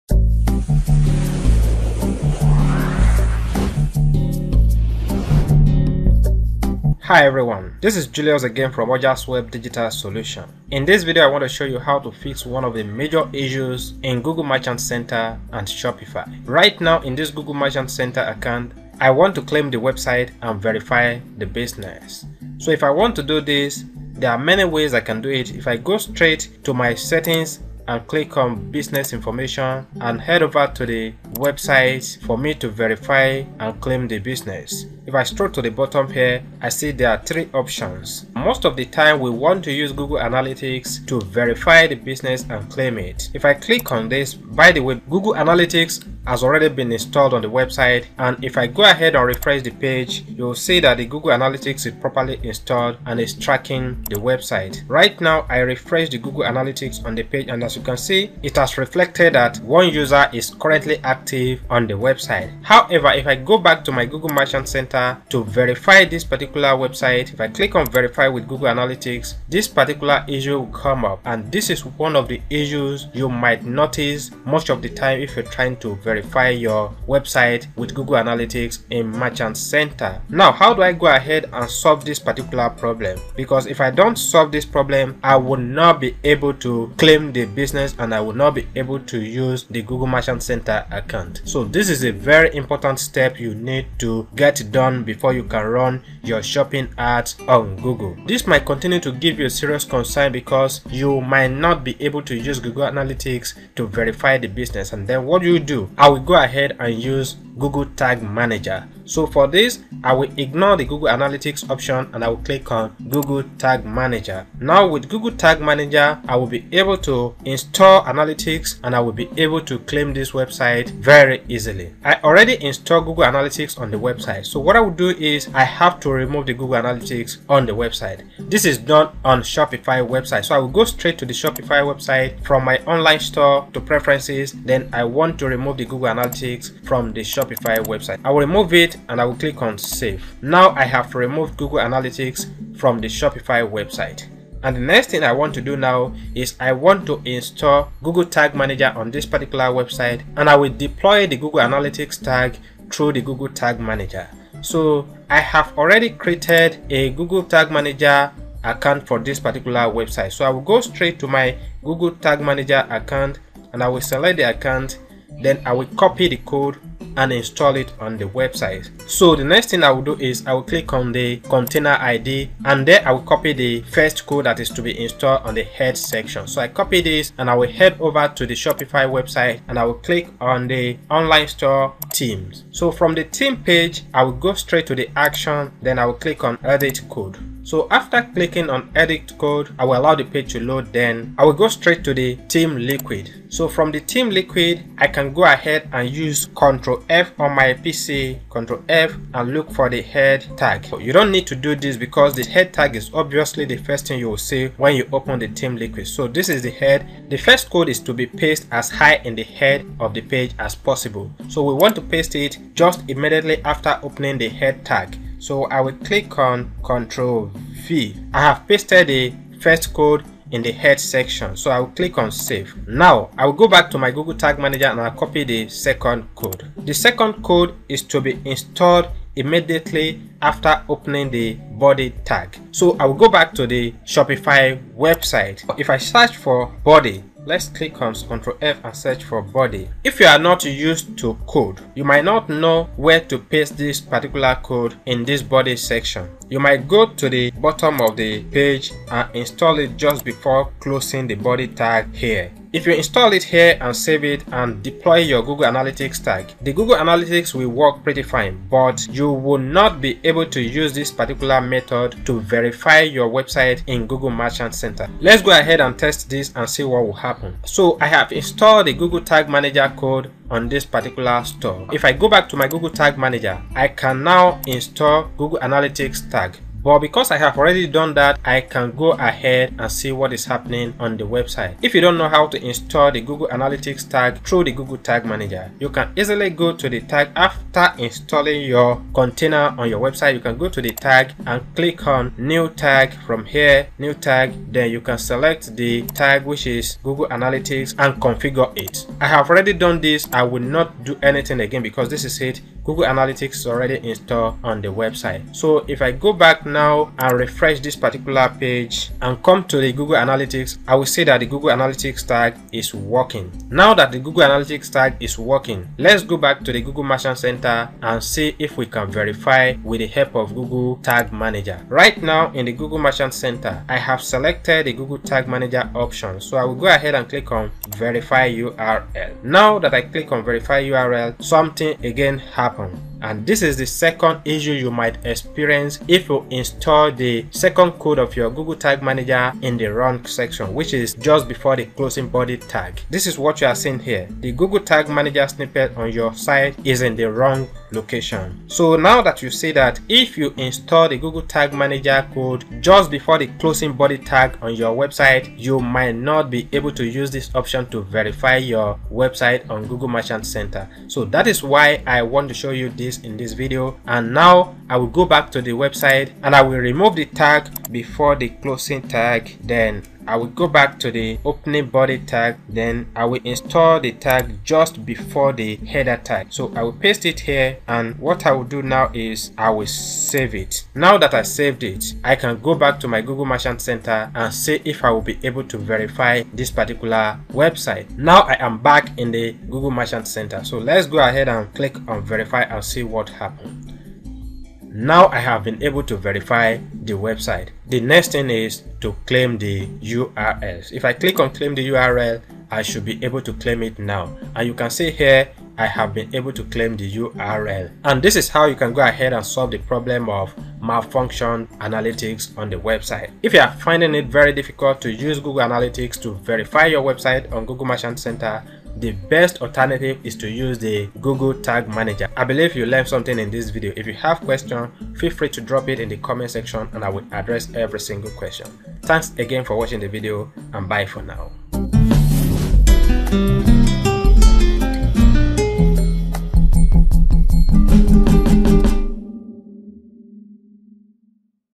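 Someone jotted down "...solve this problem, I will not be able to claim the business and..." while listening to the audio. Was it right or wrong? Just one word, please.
right.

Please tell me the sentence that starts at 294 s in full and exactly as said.
Then you can select the tag which is Google Analytics and configure it.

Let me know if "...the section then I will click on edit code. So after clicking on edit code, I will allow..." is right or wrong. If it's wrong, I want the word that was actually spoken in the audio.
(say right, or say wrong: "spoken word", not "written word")
wrong: "action", not "section".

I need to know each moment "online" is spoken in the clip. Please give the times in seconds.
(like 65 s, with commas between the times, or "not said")
132 s, 181 s.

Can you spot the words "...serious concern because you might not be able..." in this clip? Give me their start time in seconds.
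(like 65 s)
99 s.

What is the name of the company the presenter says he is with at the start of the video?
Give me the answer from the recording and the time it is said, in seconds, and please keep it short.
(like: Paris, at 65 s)
Ojasweb Digital Solution, at 8 s.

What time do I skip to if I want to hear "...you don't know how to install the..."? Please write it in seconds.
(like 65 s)
281 s.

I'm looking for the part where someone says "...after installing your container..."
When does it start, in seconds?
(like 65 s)
287 s.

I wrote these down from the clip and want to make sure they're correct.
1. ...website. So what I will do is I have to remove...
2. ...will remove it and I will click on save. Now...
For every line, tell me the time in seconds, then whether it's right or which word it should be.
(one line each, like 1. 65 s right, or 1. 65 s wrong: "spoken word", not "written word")
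1. 123 s right
2. 138 s right.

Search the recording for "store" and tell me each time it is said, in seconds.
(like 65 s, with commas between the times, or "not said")
133 s, 181 s, 271 s.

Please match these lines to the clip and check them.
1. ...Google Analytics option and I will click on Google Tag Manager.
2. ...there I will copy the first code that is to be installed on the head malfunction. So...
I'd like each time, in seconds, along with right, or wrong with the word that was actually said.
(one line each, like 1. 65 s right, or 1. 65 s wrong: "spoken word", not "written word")
1. 110 s right
2. 172 s wrong: "section", not "malfunction".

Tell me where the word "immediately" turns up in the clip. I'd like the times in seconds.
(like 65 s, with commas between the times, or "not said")
213 s, 229 s.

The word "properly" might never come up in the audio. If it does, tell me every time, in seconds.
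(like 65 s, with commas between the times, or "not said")
51 s.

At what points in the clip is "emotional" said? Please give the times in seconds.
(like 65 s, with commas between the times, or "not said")
not said.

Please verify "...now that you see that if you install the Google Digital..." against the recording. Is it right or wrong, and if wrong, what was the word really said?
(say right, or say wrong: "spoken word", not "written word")
wrong: "Tag", not "Digital".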